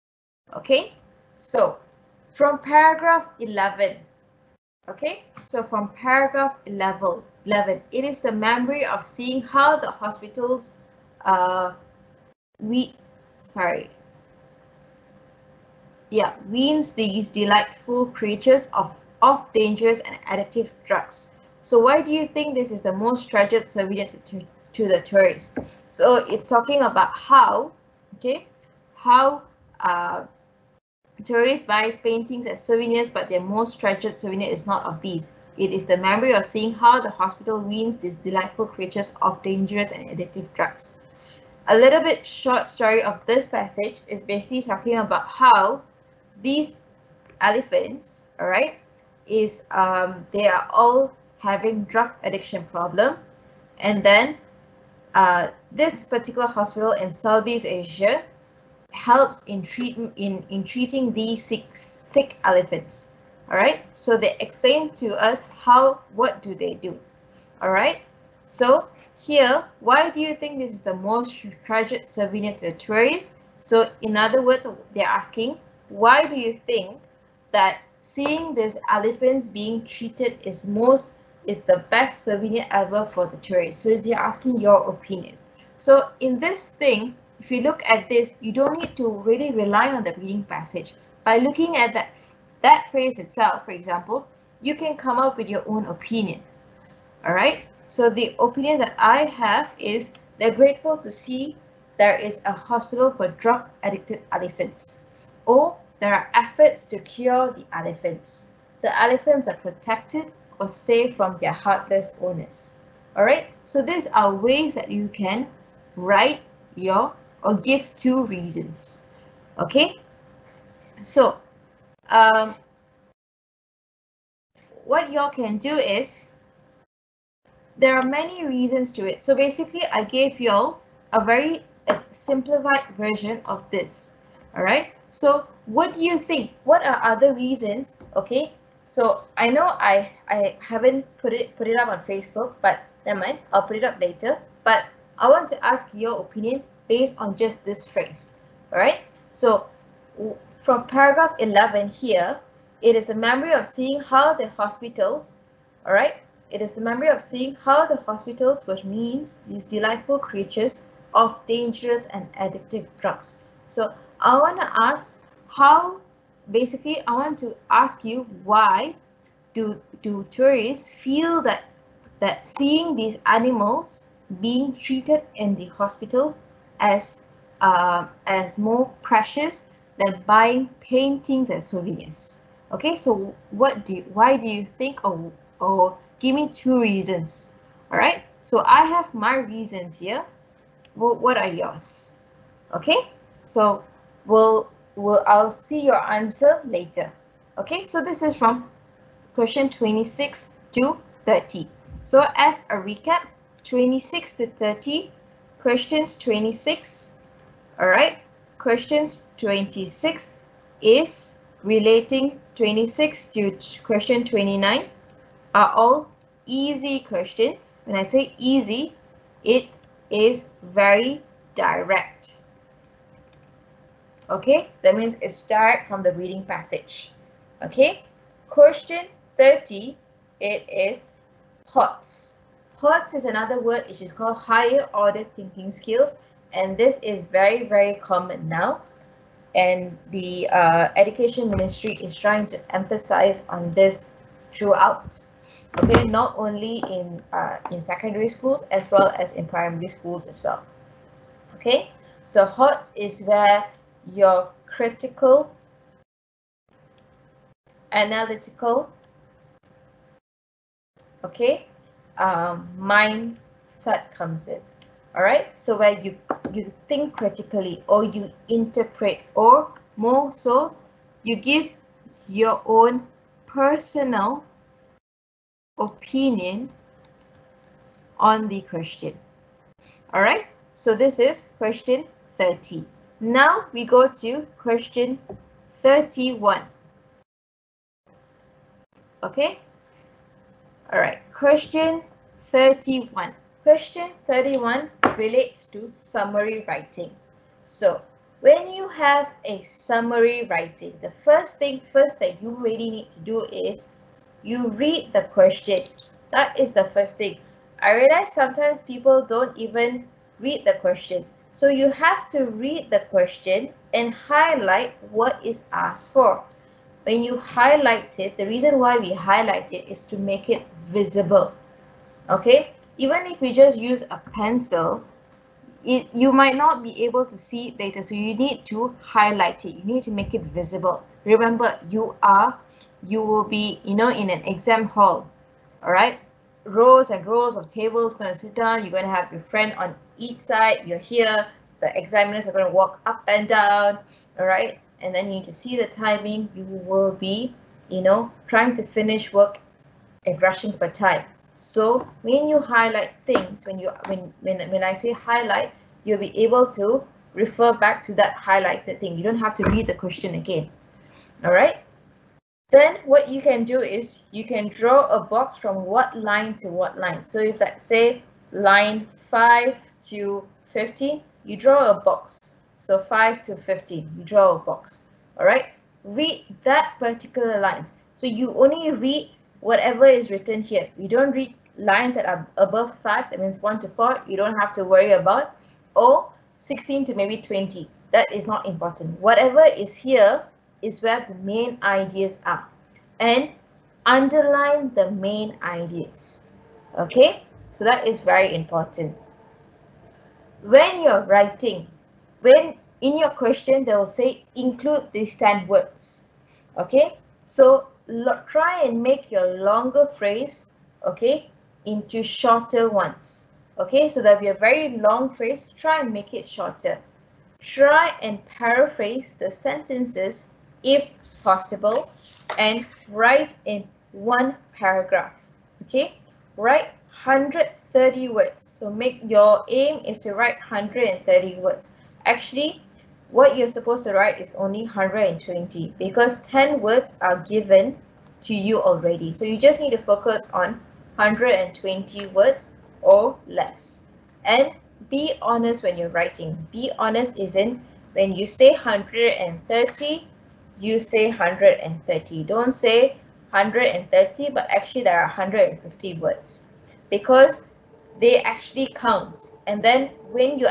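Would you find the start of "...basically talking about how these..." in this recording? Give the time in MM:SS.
00:44.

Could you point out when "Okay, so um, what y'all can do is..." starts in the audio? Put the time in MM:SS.
01:59.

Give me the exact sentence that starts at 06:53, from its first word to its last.
Okay, so that'll be a very long phrase.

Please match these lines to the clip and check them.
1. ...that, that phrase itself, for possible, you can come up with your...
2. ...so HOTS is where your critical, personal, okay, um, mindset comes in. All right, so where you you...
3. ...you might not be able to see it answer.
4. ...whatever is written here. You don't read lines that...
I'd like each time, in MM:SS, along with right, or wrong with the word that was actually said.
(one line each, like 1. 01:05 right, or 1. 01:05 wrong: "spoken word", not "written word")
1. 01:31 wrong: "example", not "possible"
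2. 04:12 wrong: "analytical", not "personal"
3. 05:26 wrong: "later", not "answer"
4. 06:19 right.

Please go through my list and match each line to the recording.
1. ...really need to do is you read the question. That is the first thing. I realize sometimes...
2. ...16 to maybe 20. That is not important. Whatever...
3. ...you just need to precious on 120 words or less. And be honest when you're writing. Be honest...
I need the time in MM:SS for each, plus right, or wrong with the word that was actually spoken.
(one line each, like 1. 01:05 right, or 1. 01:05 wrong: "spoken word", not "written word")
1. 05:02 right
2. 06:26 right
3. 07:19 wrong: "focus", not "precious".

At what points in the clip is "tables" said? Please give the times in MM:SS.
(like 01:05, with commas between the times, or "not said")
05:37.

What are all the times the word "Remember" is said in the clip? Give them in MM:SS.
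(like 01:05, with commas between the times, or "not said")
05:31.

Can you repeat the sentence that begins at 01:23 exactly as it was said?
So is he asking your opinion?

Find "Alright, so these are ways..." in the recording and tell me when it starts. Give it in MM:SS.
01:53.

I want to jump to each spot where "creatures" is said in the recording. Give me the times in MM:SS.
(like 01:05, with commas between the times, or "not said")
00:18, 00:38, 02:40.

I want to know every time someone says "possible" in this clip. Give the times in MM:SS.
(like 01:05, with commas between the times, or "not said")
07:01.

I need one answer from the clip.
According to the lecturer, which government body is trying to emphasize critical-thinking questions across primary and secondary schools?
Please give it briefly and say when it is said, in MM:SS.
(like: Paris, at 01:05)
education ministry, at 04:00.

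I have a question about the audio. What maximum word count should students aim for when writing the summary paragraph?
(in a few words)
130.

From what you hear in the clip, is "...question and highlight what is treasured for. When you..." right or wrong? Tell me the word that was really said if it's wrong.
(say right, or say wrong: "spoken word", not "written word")
wrong: "asked", not "treasured".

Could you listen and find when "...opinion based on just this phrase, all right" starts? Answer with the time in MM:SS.
02:26.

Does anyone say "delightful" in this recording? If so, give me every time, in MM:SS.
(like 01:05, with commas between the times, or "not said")
00:17, 00:38, 02:39.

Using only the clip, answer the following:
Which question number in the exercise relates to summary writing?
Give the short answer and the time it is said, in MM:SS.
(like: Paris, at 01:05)
31, at 04:53.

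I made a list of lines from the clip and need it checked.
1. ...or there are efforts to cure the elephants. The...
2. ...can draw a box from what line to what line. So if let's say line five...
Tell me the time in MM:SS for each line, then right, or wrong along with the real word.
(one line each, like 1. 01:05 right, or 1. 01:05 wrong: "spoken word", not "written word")
1. 01:45 right
2. 06:04 right.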